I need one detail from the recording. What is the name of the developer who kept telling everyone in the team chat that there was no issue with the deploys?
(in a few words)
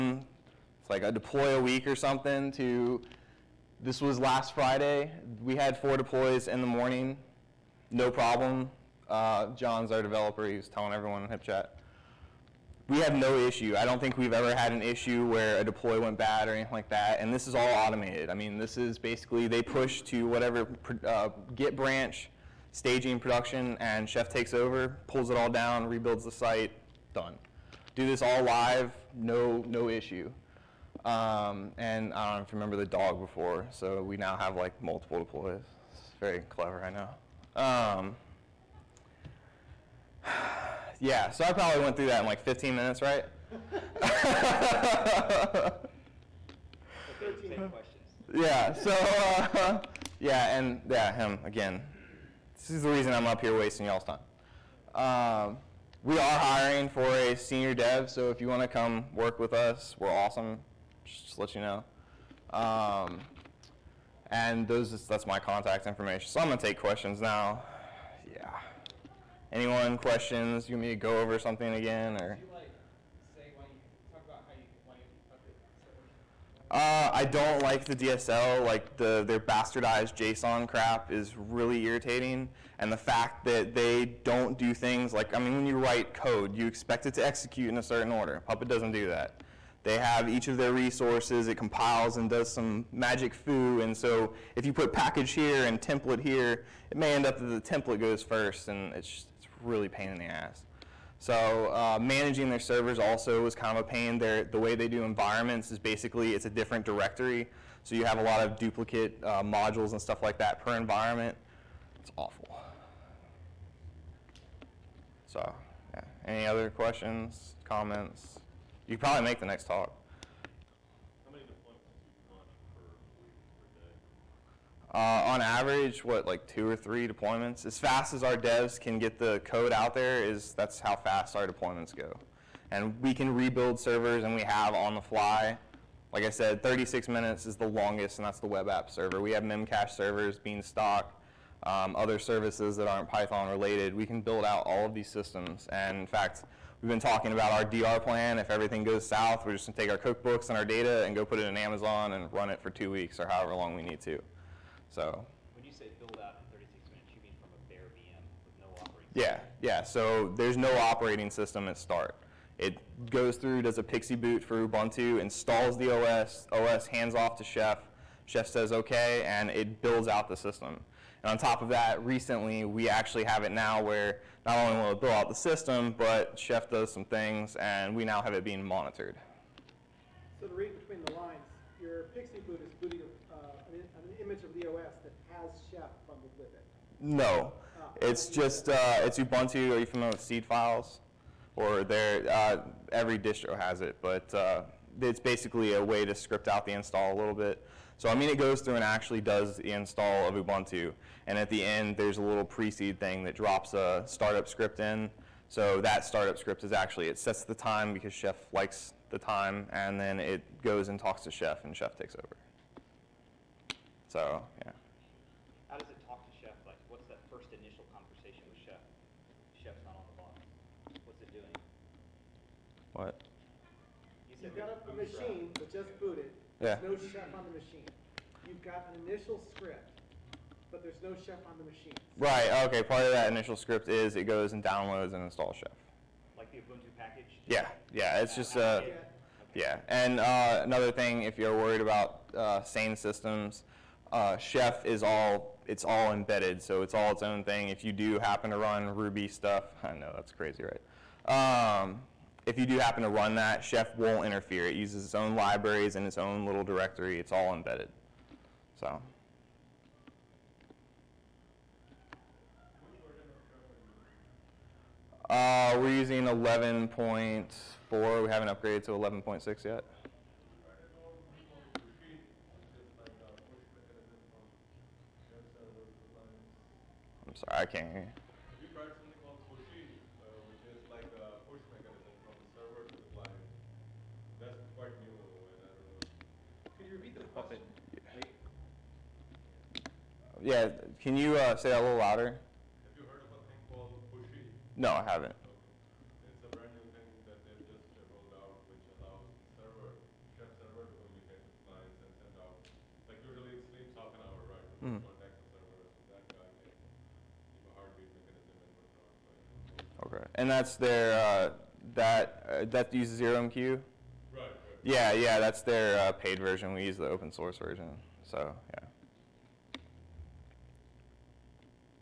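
John.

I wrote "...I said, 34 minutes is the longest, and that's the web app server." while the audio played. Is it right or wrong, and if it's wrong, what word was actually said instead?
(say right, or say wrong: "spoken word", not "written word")
wrong: "36", not "34".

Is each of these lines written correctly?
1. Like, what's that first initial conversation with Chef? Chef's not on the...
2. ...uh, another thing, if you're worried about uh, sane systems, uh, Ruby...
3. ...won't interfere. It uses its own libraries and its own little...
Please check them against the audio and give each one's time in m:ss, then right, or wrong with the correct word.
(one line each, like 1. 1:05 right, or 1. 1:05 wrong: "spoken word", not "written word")
1. 3:36 right
2. 4:00 wrong: "Chef", not "Ruby"
3. 4:13 right.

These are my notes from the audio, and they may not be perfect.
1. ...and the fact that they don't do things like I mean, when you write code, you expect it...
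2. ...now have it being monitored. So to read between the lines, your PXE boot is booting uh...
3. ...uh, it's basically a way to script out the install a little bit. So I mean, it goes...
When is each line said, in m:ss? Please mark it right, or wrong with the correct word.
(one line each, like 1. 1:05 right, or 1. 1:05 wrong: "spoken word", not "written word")
1. 1:22 right
2. 2:58 right
3. 3:14 right.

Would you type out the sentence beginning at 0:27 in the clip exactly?
Do this all live, no no issue.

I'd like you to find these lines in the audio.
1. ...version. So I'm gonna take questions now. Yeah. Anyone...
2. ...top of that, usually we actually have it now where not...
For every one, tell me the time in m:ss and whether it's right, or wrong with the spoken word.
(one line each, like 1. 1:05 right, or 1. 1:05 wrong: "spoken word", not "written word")
1. 1:05 wrong: "information", not "version"
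2. 2:51 wrong: "recently", not "usually".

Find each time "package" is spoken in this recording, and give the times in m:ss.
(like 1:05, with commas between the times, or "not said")
1:34, 3:56.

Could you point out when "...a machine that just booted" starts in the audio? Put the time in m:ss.
3:44.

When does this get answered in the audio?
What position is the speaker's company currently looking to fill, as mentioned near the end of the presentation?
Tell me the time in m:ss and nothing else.
0:57.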